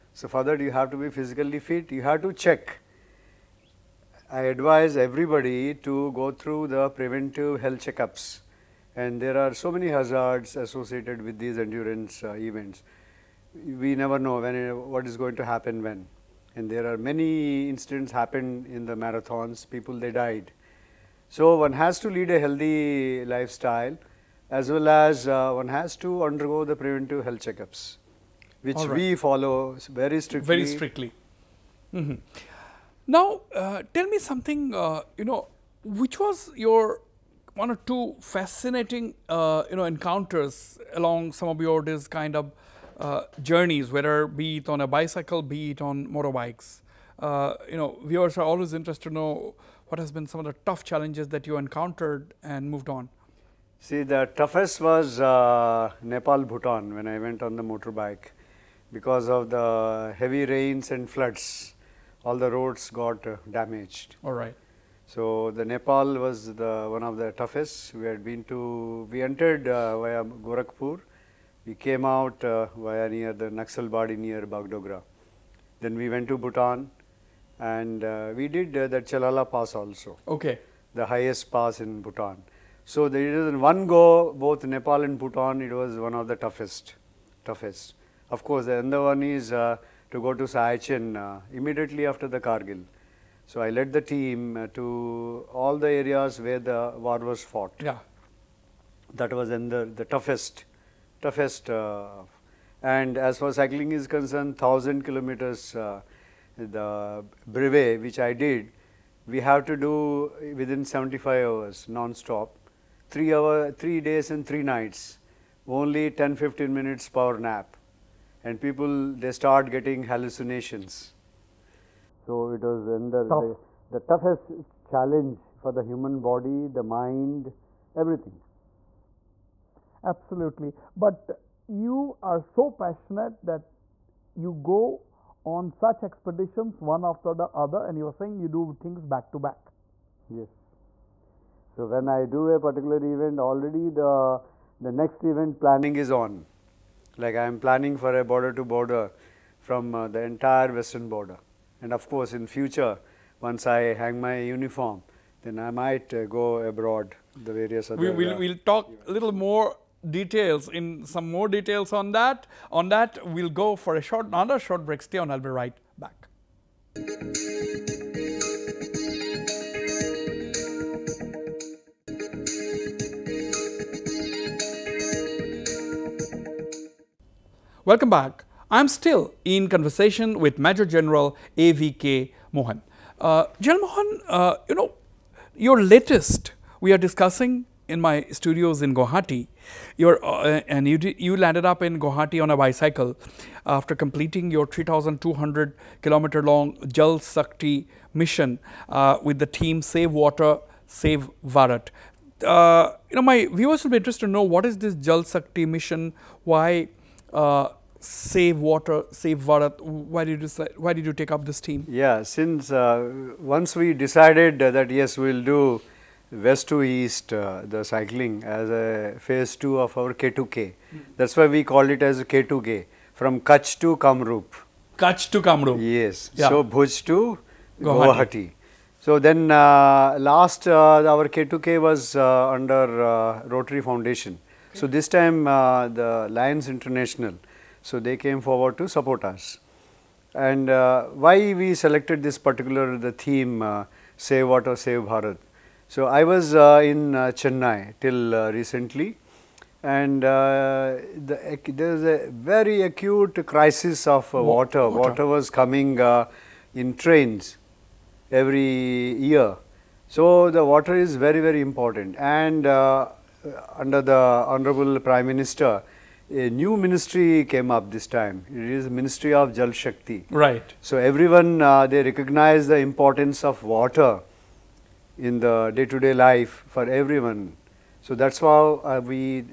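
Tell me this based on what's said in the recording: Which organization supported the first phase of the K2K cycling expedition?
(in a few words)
Rotary Foundation.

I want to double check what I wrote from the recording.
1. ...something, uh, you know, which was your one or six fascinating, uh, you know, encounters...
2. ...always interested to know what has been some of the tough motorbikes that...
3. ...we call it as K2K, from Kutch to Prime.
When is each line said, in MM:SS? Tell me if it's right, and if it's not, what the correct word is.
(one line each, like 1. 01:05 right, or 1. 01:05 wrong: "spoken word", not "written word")
1. 00:34 wrong: "two", not "six"
2. 00:48 wrong: "challenges", not "motorbikes"
3. 03:41 wrong: "Kamrup", not "Prime".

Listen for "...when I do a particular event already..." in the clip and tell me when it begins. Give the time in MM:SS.
02:21.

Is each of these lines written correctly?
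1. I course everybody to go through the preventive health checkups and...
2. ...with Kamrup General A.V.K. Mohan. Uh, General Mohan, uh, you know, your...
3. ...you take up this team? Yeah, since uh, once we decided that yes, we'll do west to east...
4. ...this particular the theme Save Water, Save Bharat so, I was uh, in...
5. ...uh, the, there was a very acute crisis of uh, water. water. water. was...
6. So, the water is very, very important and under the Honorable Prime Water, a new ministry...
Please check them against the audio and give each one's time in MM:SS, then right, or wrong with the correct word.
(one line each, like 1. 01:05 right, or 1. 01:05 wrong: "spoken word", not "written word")
1. 00:04 wrong: "advise", not "course"
2. 03:00 wrong: "Major", not "Kamrup"
3. 03:31 right
4. 04:02 right
5. 04:10 right
6. 04:20 wrong: "Minister", not "Water".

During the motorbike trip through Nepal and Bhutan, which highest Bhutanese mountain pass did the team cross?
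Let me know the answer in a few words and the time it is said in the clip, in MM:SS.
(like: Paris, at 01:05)
Chalala pass, at 01:19.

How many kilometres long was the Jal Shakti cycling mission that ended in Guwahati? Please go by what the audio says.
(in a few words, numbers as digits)
3,200 kilometers.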